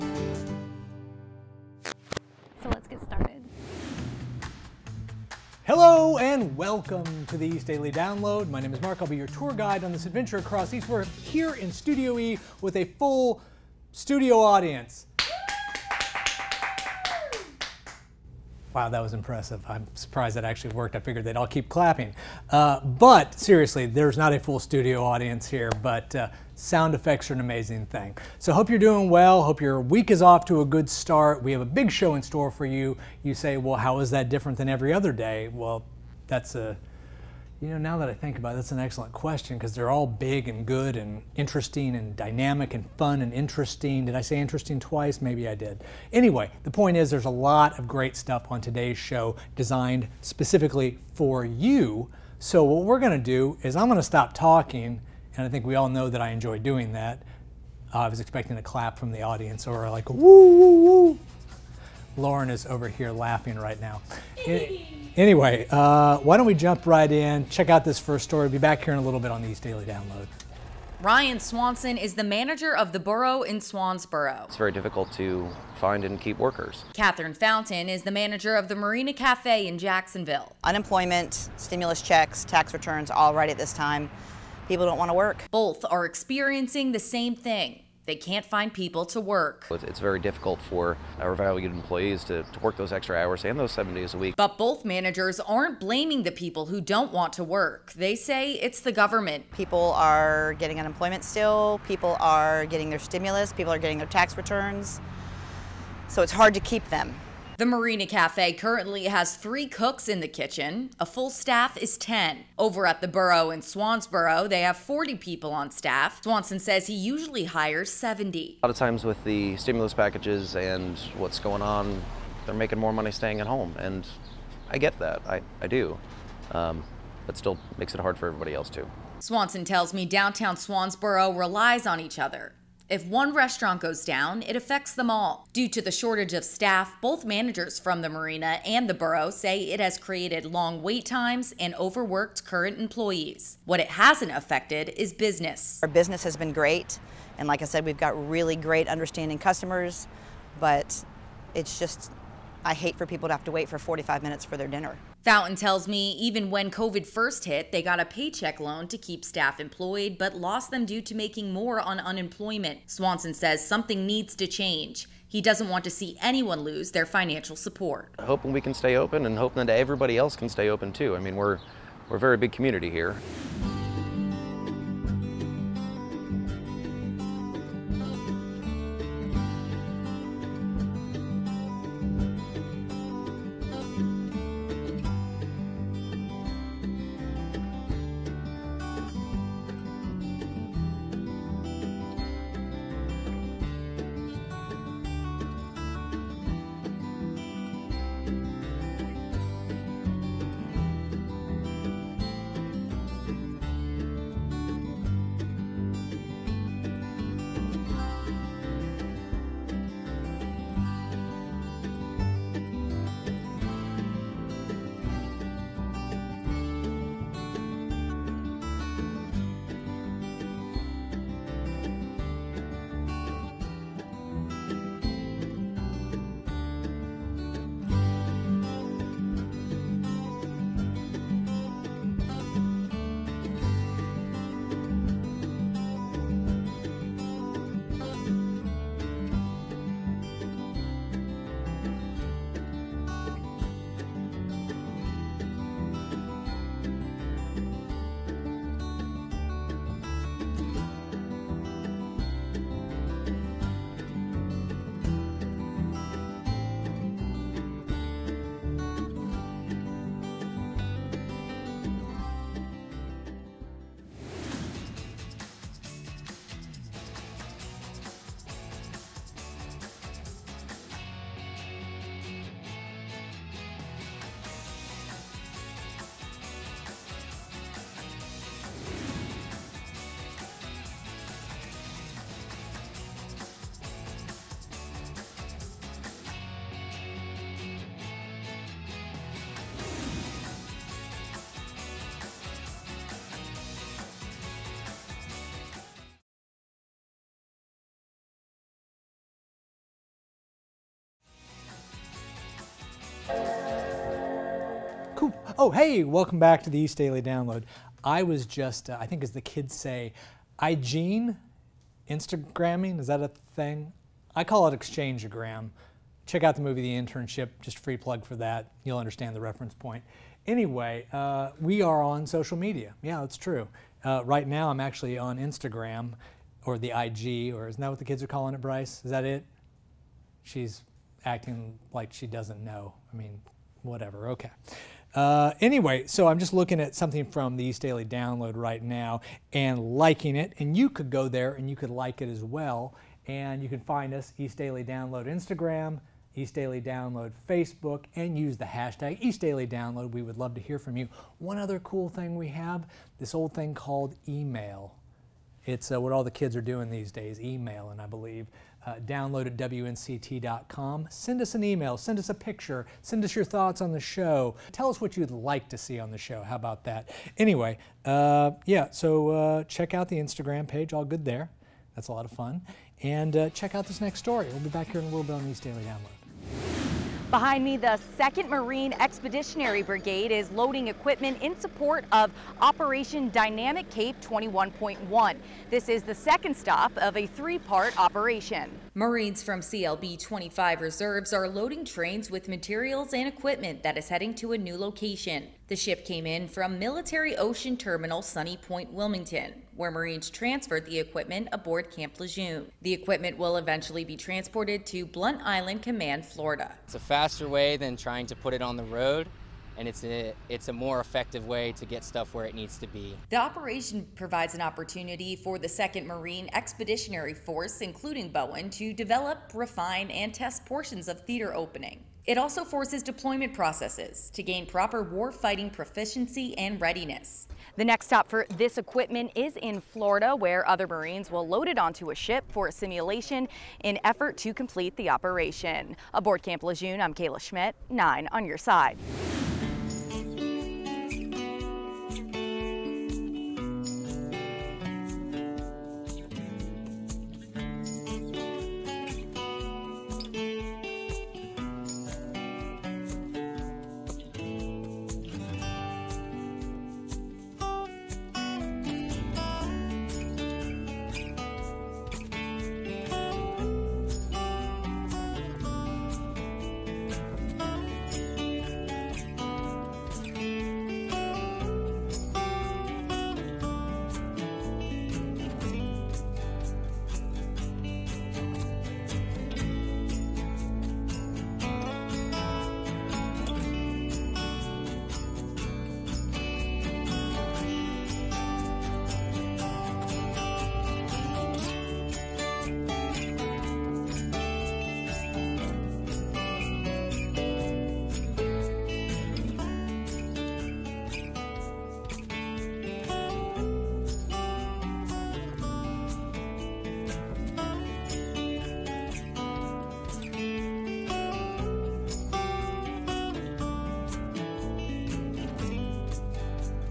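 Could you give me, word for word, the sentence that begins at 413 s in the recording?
The operation provides an opportunity for the 2nd Marine Expeditionary Force, including Bowen, to develop, refine, and test portions of theater opening.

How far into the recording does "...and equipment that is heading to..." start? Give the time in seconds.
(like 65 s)
393 s.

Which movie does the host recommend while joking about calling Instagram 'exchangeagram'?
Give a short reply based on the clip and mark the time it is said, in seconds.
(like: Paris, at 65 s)
The Internship, at 316 s.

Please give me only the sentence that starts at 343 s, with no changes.
And you can find us, East Daily Download Instagram, East Daily Download Facebook, and use the hashtag East Daily Download.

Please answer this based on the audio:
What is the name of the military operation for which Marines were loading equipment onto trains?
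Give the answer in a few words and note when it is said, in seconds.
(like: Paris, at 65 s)
Operation Dynamic Cape 21.1, at 382 s.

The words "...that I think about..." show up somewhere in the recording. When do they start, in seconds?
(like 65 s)
37 s.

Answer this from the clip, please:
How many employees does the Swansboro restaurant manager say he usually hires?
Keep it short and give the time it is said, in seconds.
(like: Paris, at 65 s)
70, at 117 s.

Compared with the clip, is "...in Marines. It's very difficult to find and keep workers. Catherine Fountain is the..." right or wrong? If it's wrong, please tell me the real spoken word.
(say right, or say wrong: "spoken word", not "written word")
wrong: "Swansboro", not "Marines".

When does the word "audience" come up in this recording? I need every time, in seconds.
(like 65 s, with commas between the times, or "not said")
14 s, 25 s, 59 s.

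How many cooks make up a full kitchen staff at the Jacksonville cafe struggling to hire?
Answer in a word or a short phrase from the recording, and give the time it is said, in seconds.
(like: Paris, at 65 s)
10, at 111 s.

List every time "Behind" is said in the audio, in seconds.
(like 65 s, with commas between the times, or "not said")
377 s.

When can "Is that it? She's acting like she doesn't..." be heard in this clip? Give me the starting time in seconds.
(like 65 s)
329 s.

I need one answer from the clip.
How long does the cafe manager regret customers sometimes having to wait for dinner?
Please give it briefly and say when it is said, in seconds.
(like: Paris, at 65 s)
45 minutes, at 153 s.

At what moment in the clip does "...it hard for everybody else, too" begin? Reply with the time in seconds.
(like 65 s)
127 s.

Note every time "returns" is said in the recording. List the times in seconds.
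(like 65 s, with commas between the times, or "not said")
82 s, 104 s.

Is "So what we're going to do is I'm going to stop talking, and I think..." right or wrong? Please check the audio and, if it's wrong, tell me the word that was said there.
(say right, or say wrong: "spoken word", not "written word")
right.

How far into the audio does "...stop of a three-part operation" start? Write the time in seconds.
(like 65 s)
386 s.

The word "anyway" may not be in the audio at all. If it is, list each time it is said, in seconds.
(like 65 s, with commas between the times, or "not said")
46 s, 65 s, 320 s, 335 s, 367 s.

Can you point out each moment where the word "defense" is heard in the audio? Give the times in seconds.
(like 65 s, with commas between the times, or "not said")
not said.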